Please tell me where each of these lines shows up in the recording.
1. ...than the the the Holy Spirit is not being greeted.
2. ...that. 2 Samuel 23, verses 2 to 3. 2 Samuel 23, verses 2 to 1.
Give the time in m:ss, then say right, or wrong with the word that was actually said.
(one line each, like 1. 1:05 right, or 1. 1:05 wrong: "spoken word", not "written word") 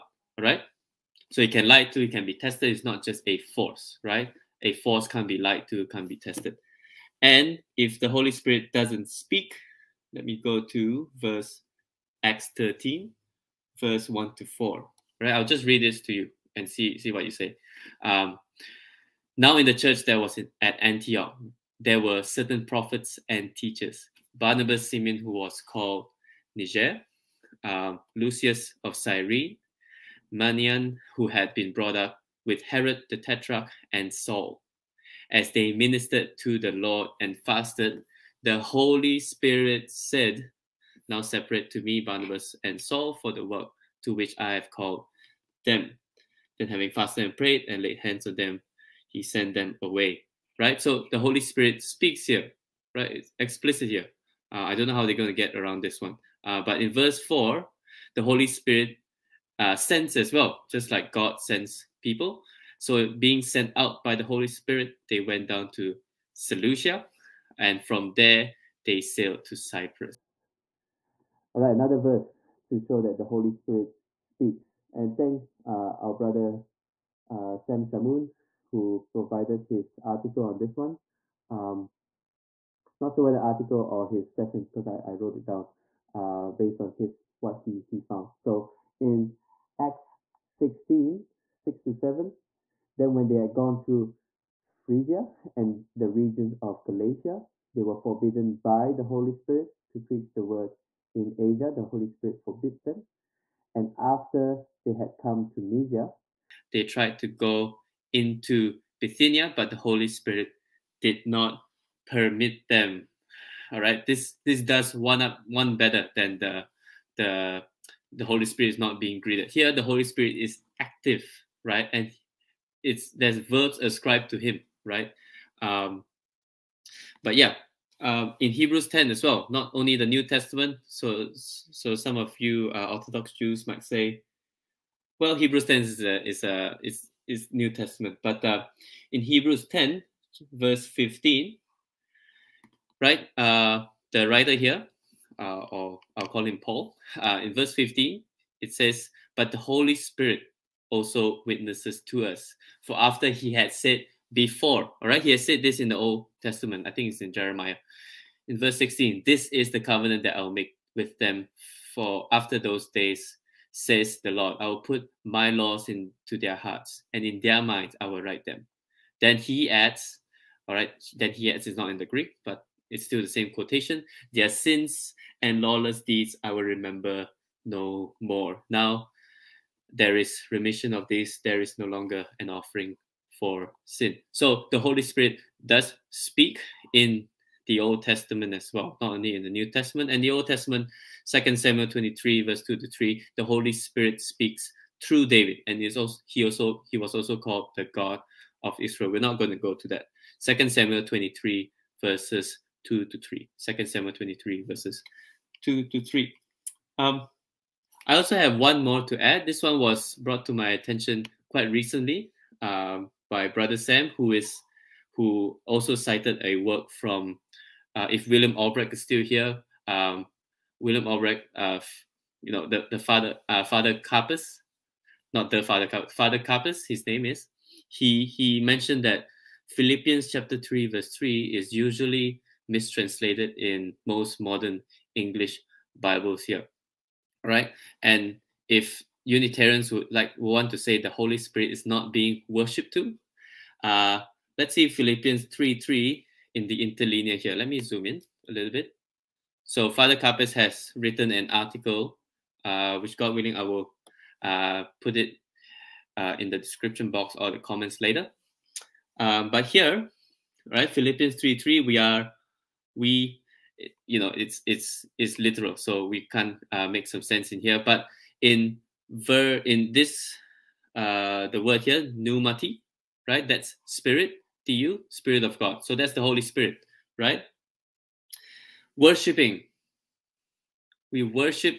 1. 1:56 right
2. 3:19 wrong: "3", not "1".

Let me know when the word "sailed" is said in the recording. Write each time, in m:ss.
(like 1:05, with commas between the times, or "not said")
1:08.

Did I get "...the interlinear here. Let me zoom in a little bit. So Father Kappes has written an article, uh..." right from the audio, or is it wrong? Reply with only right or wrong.
right.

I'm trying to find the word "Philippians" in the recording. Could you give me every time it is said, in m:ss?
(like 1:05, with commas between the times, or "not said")
3:49, 4:04, 4:20.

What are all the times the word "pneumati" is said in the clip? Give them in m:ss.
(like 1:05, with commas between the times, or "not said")
4:32.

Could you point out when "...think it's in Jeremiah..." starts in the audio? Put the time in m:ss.
2:36.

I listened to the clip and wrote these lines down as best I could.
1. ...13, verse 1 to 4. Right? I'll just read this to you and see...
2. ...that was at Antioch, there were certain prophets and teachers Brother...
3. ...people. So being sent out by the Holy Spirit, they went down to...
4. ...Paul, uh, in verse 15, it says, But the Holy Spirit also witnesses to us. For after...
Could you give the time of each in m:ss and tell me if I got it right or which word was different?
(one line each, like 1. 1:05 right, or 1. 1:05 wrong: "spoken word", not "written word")
1. 0:12 right
2. 0:20 wrong: "Barnabas", not "Brother"
3. 1:02 right
4. 2:26 right.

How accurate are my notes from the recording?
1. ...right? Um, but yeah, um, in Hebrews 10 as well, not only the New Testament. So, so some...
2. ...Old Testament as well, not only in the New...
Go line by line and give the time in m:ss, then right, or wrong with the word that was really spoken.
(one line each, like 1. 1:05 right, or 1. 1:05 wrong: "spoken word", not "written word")
1. 2:04 right
2. 3:07 right.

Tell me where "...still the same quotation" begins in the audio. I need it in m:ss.
2:53.